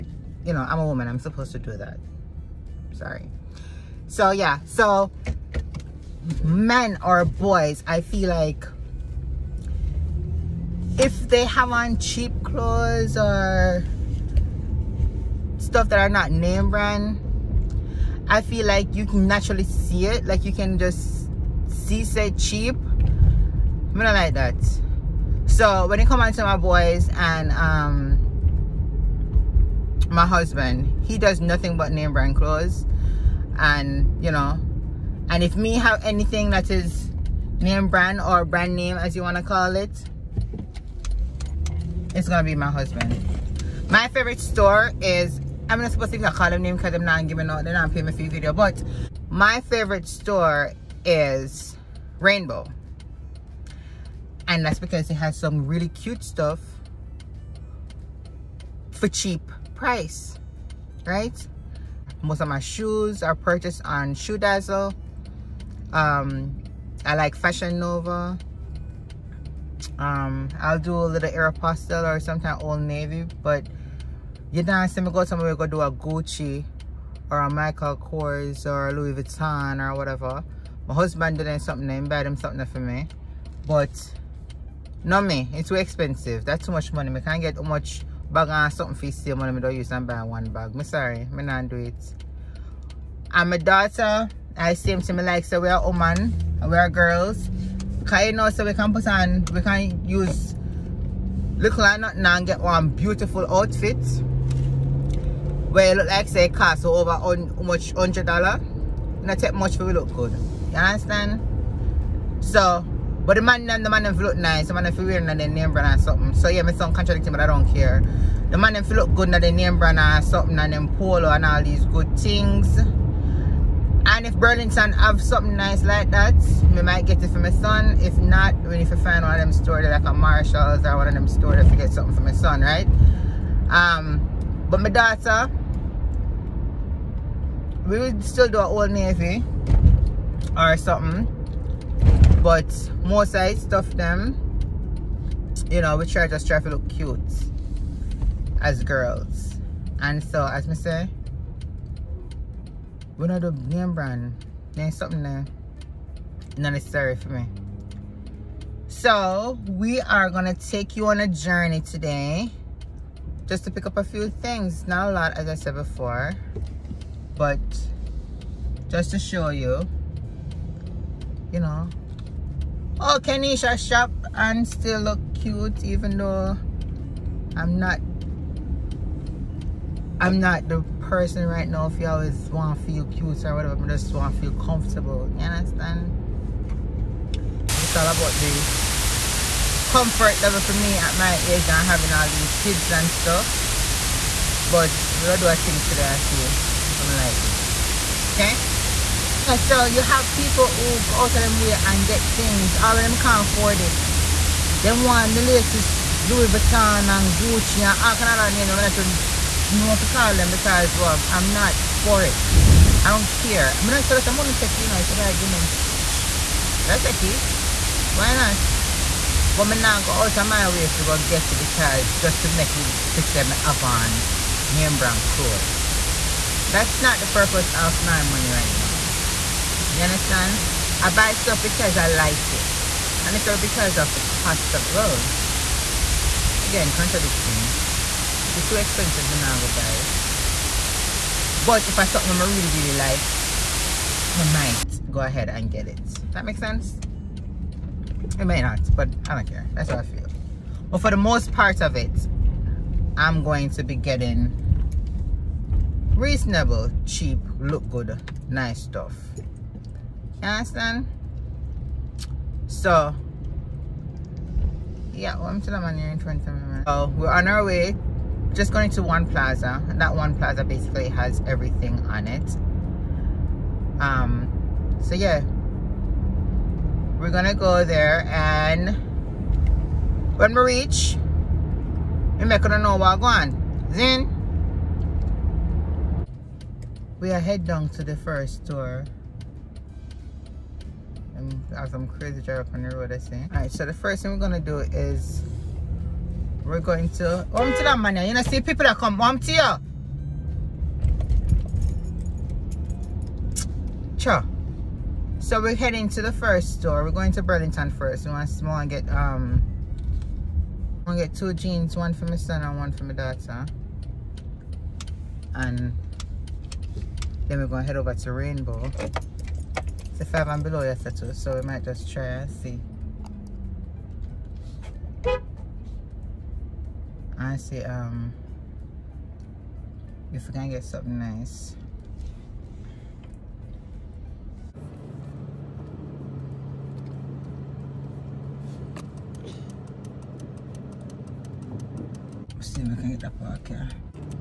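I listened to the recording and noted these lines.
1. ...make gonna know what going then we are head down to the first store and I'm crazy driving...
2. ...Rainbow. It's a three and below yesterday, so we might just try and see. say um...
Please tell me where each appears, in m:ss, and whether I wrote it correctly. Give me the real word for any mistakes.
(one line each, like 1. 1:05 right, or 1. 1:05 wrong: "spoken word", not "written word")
1. 4:42 right
2. 5:18 wrong: "five", not "three".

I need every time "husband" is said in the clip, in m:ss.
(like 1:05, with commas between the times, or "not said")
0:30, 0:42, 1:20.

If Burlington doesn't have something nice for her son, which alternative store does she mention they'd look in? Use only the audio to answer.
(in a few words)
Marshalls.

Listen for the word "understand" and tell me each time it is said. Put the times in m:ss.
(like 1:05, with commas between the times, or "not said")
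1:50, 3:05, 3:50, 4:20.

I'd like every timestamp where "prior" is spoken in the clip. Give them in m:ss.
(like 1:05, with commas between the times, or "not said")
not said.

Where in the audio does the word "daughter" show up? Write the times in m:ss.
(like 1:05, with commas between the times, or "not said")
1:33, 2:14, 5:13.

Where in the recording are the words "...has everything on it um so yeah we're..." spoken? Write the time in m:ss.
4:31.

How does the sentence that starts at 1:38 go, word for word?
Kaya so we can put on, we can use look like nothing and get one beautiful outfit.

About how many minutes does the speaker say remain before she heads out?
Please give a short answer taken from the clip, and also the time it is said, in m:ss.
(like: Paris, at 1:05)
20, at 4:26.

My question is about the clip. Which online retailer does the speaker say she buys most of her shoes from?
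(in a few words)
Shoe Dazzle.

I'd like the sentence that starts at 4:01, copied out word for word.
But if I something I really, really like, I might go ahead and get it.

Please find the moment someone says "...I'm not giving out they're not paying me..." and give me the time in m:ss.
0:46.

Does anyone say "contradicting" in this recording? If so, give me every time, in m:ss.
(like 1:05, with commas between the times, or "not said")
1:56, 3:56.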